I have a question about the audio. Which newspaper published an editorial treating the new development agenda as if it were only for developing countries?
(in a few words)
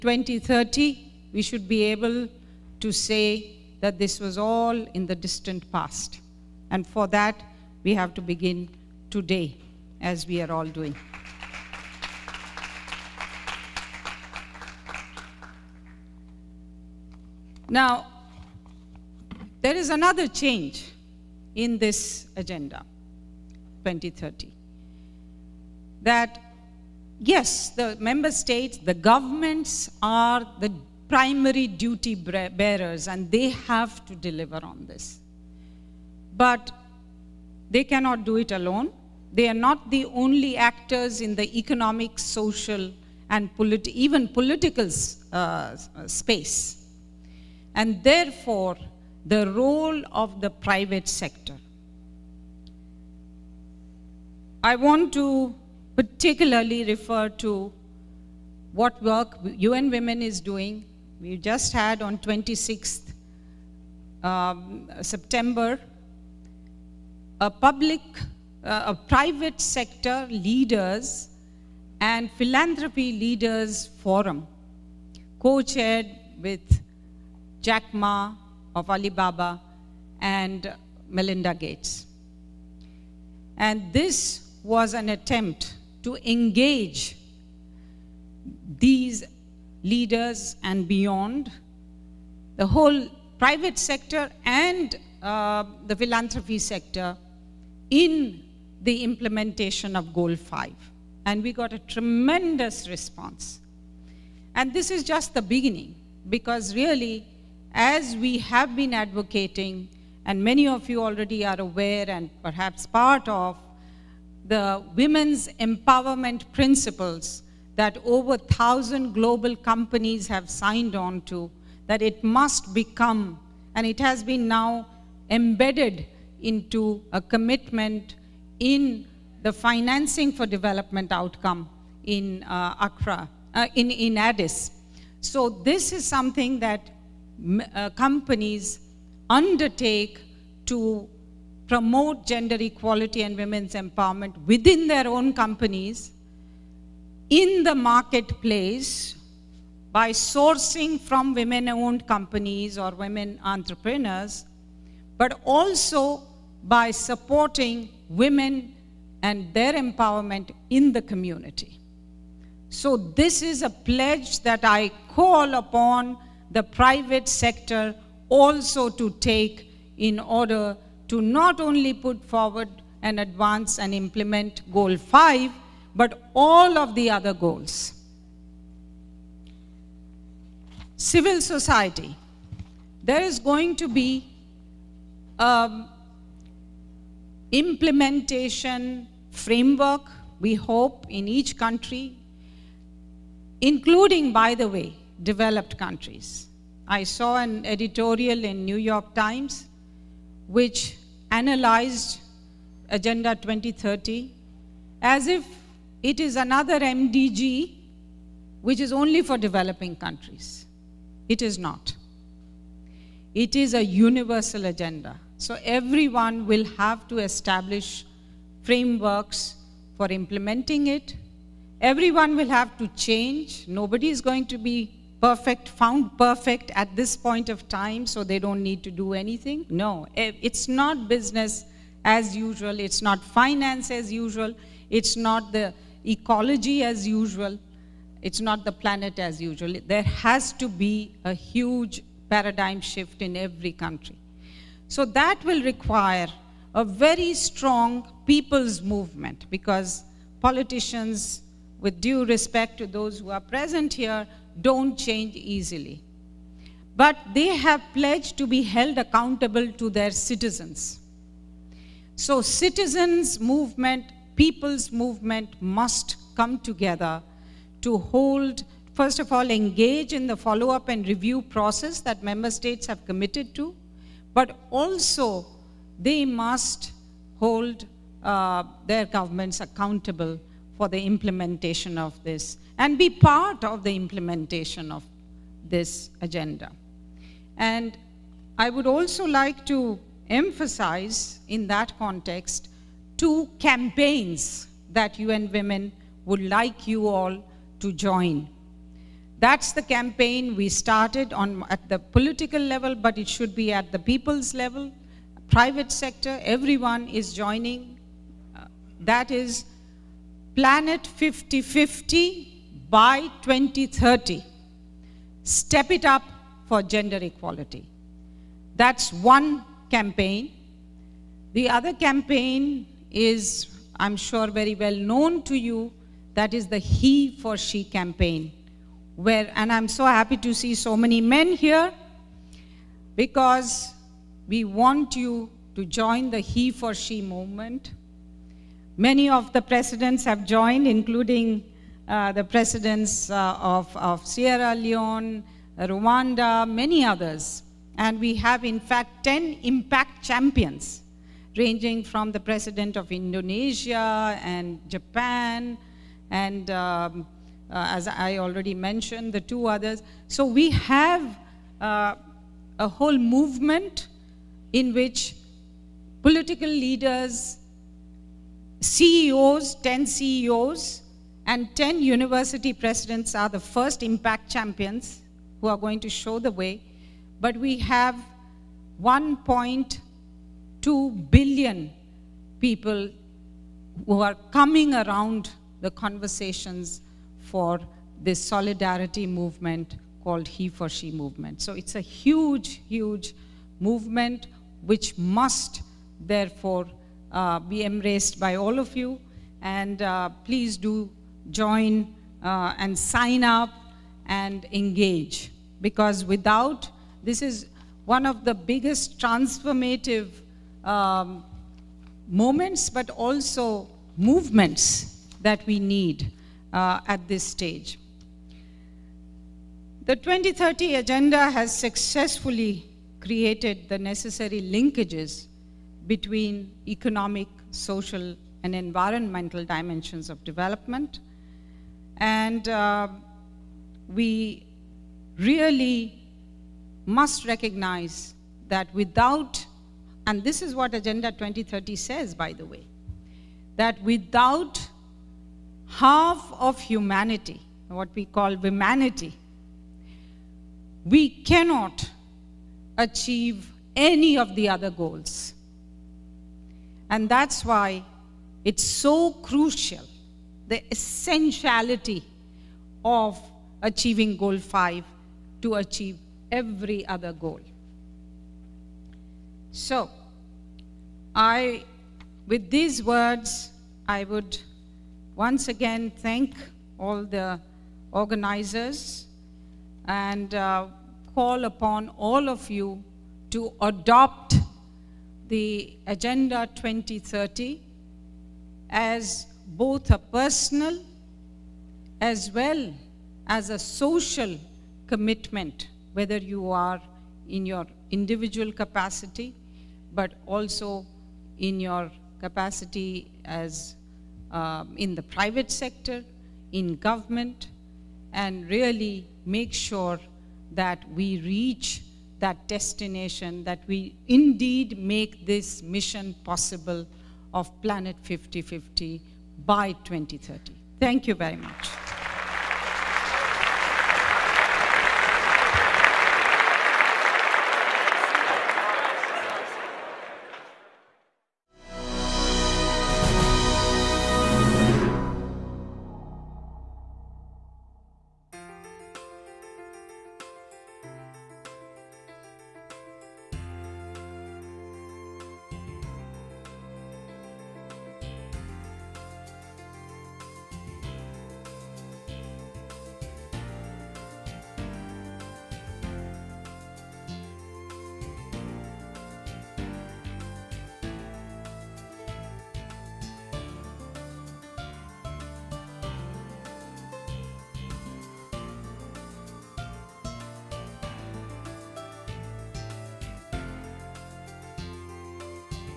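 New York Times.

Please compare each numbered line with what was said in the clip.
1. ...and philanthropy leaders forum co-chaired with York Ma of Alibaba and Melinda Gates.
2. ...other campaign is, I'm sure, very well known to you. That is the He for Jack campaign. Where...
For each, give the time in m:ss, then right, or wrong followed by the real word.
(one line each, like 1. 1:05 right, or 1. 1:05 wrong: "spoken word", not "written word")
1. 1:12 wrong: "Jack", not "York"
2. 5:21 wrong: "She", not "Jack".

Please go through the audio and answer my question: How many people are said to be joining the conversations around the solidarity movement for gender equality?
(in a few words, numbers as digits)
1.2 billion.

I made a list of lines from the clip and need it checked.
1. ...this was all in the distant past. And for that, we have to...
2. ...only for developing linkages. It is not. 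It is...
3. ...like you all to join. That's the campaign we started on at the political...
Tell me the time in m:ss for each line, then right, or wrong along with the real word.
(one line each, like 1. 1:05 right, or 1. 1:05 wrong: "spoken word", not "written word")
1. 0:03 right
2. 3:28 wrong: "countries", not "linkages"
3. 4:56 right.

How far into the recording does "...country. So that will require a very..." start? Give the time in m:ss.
4:03.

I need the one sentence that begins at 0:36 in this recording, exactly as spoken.
But they cannot do it alone.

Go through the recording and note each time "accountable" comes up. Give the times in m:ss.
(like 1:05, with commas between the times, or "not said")
4:18, 4:39.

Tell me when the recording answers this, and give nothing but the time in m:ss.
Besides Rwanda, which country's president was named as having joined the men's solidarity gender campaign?
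5:44.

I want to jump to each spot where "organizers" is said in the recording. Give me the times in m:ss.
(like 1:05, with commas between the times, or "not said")
7:58.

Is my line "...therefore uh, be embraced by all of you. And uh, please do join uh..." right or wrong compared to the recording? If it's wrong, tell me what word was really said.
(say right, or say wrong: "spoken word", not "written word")
right.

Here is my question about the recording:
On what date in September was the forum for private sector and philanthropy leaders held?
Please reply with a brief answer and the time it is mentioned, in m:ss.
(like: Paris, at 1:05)
26th, at 1:02.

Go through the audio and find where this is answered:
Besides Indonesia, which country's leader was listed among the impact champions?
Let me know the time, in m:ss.
5:54.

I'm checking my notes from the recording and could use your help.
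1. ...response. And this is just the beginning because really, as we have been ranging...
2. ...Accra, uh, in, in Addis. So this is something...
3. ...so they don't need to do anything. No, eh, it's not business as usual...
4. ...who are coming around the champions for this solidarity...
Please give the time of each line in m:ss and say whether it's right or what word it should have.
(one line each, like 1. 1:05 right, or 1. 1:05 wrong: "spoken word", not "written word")
1. 1:42 wrong: "advocating", not "ranging"
2. 2:12 right
3. 3:48 right
4. 6:24 wrong: "conversations", not "champions".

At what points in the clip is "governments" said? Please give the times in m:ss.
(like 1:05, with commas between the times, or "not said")
0:28, 4:39, 8:26.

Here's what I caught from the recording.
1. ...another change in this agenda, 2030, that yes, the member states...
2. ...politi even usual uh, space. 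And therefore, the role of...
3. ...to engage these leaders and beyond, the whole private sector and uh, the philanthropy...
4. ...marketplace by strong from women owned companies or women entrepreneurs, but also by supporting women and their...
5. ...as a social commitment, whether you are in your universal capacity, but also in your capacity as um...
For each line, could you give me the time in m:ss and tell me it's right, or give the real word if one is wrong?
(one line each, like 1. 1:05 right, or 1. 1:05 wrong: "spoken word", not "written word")
1. 0:19 right
2. 0:43 wrong: "political", not "usual"
3. 1:26 right
4. 2:27 wrong: "sourcing", not "strong"
5. 8:13 wrong: "individual", not "universal".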